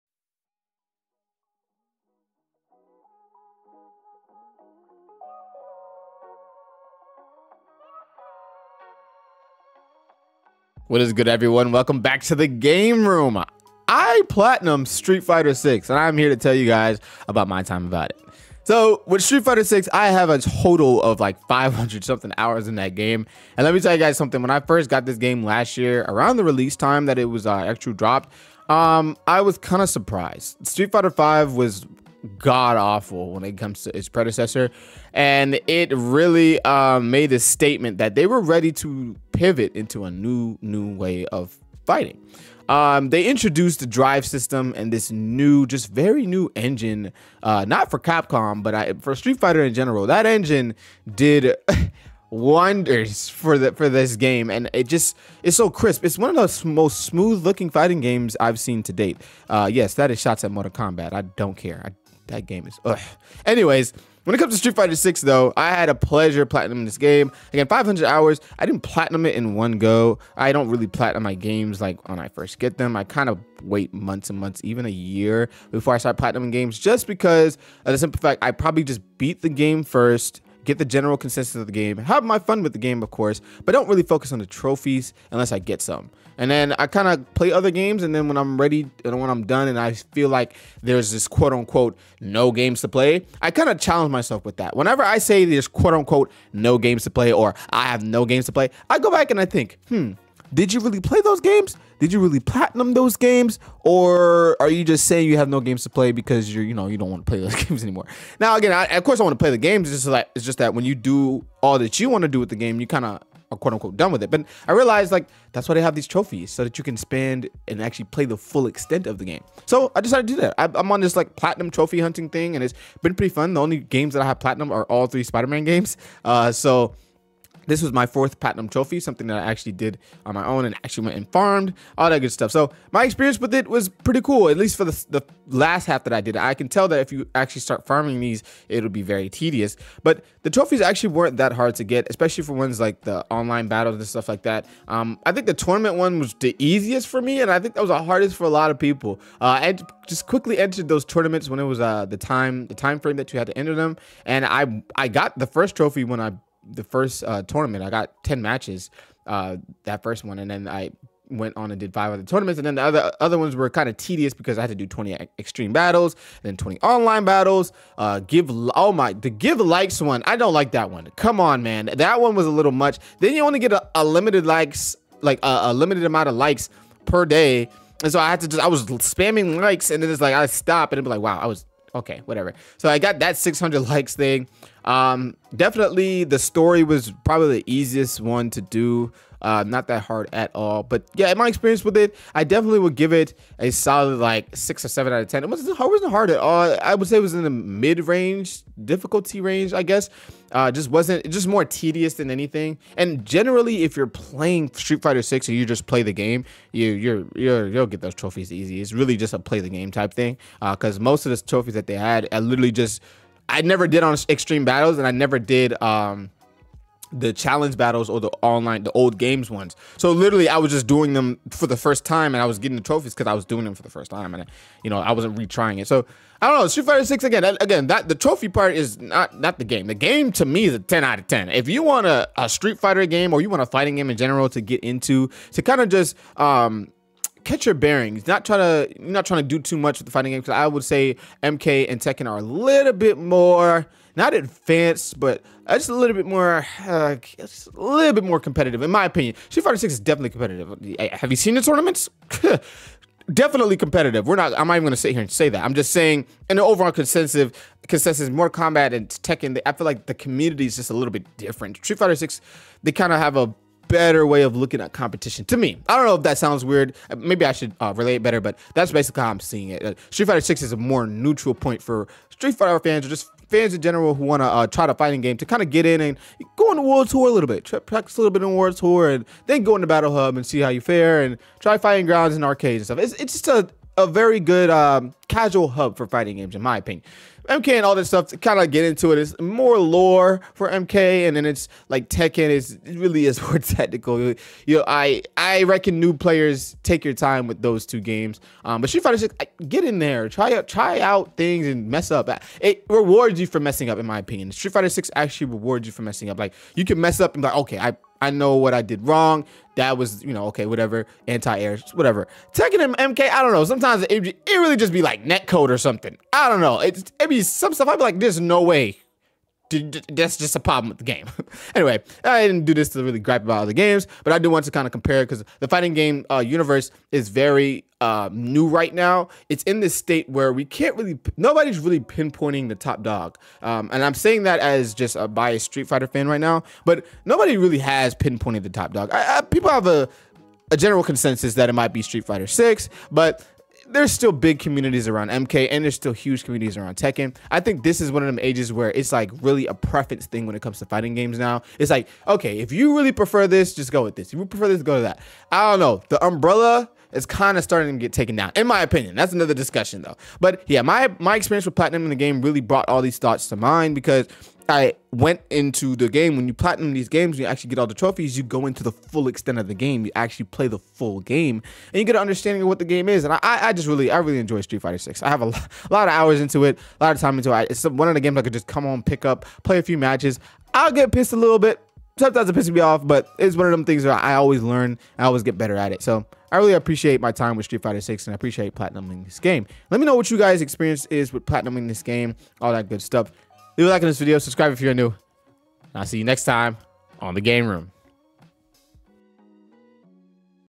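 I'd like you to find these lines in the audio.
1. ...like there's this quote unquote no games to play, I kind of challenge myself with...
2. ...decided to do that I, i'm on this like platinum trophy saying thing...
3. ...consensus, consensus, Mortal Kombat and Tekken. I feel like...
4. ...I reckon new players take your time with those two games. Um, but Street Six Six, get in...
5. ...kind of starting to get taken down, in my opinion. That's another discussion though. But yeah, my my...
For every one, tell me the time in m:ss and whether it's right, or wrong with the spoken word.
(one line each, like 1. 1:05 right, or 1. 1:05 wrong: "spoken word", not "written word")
1. 1:30 right
2. 2:00 wrong: "hunting", not "saying"
3. 4:16 right
4. 4:55 wrong: "Fighter", not "Six"
5. 5:57 right.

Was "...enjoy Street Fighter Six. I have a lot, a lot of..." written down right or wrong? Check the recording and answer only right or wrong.
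right.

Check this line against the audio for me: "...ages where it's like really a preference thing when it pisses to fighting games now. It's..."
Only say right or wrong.
wrong.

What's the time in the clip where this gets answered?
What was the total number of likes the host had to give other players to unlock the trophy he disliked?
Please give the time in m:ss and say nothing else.
3:03.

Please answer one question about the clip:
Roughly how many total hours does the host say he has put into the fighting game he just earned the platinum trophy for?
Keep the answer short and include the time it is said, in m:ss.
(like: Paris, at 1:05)
500 something hours, at 0:21.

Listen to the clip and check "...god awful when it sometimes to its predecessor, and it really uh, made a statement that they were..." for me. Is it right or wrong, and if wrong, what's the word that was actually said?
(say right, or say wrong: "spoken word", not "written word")
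wrong: "comes", not "sometimes".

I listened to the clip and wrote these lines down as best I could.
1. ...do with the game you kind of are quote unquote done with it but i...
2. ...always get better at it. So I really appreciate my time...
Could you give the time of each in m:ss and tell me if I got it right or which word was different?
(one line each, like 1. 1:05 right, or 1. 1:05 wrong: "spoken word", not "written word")
1. 1:52 right
2. 6:25 right.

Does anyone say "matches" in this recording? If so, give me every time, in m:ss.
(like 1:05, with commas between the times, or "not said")
2:38, 6:19.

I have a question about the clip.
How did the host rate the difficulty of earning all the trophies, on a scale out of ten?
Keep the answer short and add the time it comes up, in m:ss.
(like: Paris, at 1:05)
6 or 7, at 3:14.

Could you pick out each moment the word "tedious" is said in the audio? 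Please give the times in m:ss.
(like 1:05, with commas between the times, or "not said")
2:19, 2:43, 3:21.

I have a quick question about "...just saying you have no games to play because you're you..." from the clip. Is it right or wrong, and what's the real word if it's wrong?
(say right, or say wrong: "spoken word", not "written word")
right.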